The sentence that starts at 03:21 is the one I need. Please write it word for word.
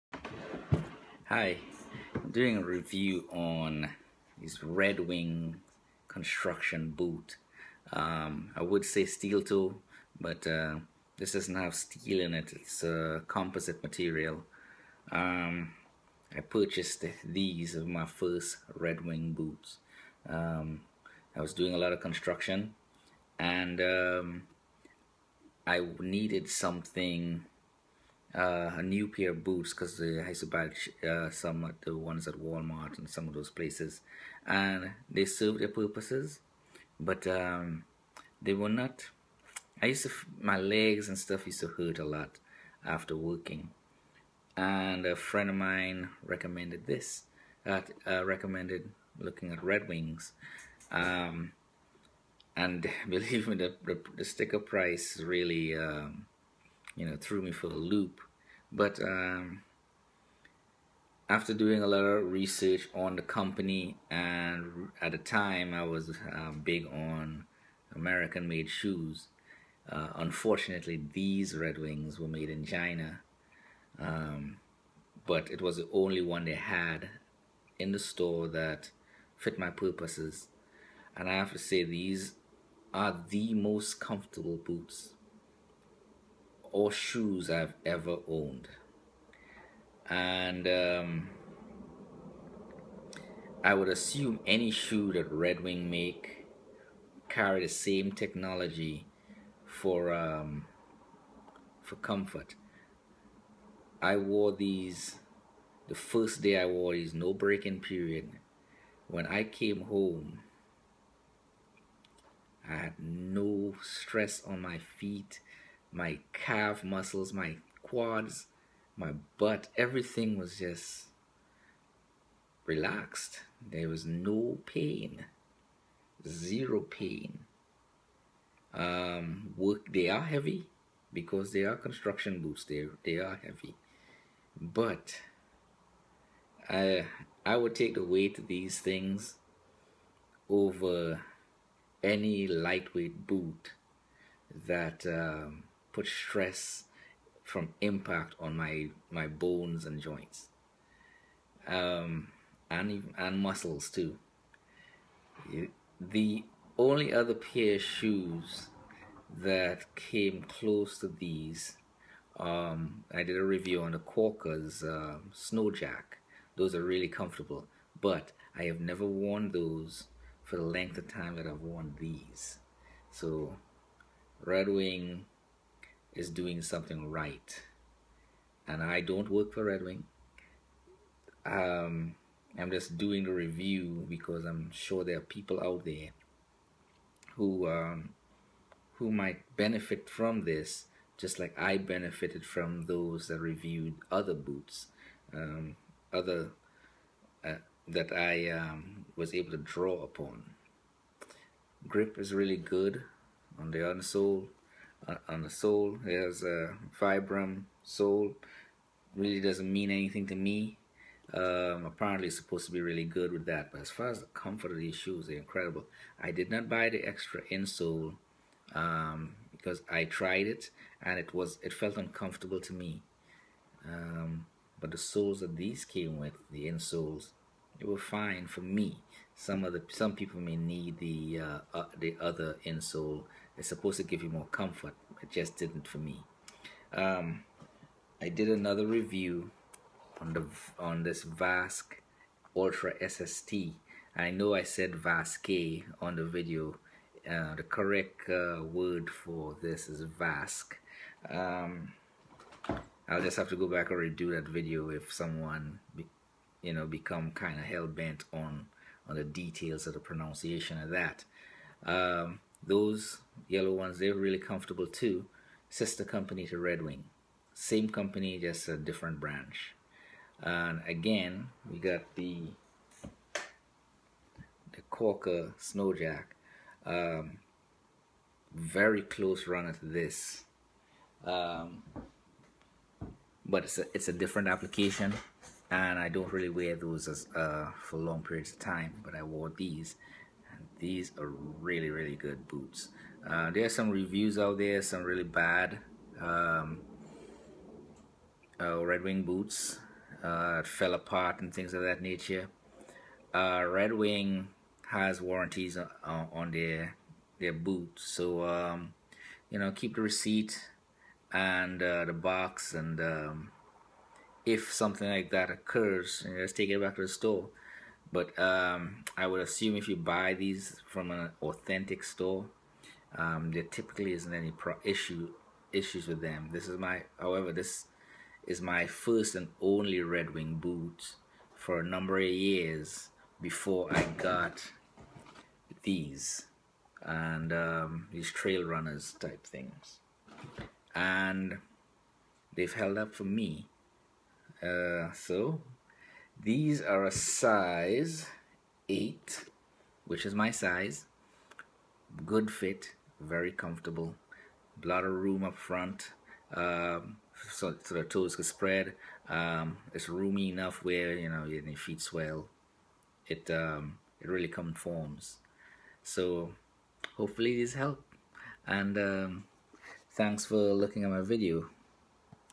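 Grip is really good on the insole on the sole.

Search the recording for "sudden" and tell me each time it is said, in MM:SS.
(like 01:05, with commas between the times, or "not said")
not said.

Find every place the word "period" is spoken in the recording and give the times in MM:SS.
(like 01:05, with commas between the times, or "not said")
01:47, 04:48.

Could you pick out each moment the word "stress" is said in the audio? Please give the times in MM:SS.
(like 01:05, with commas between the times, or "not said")
01:53, 02:26.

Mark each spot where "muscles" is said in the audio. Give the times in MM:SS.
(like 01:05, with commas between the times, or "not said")
01:56, 02:33.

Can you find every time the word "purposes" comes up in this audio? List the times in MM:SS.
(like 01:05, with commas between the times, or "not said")
00:35, 01:19.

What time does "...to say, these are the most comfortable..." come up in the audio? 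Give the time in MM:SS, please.
01:21.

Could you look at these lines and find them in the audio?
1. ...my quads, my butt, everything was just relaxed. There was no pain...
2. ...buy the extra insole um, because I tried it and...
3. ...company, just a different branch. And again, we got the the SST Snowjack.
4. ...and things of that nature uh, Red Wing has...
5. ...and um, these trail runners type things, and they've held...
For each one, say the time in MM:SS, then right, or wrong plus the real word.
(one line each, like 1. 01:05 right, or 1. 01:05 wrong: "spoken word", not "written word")
1. 01:57 right
2. 03:36 right
3. 04:27 wrong: "Corker", not "SST"
4. 05:01 right
5. 05:37 right.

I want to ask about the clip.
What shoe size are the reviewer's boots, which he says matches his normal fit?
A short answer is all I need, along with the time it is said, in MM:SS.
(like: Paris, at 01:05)
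8, at 05:48.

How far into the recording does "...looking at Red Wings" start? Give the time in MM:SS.
00:49.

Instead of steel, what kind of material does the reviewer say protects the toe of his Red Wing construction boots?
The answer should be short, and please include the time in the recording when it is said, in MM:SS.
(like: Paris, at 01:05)
composite, at 00:13.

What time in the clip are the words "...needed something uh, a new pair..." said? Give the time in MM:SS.
00:26.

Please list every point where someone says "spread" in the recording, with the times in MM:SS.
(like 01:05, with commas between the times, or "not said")
05:58.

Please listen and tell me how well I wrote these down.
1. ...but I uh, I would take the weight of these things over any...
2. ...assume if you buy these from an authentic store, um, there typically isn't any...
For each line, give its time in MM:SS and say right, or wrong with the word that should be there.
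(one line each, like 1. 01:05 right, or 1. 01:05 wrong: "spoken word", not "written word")
1. 02:14 right
2. 05:19 right.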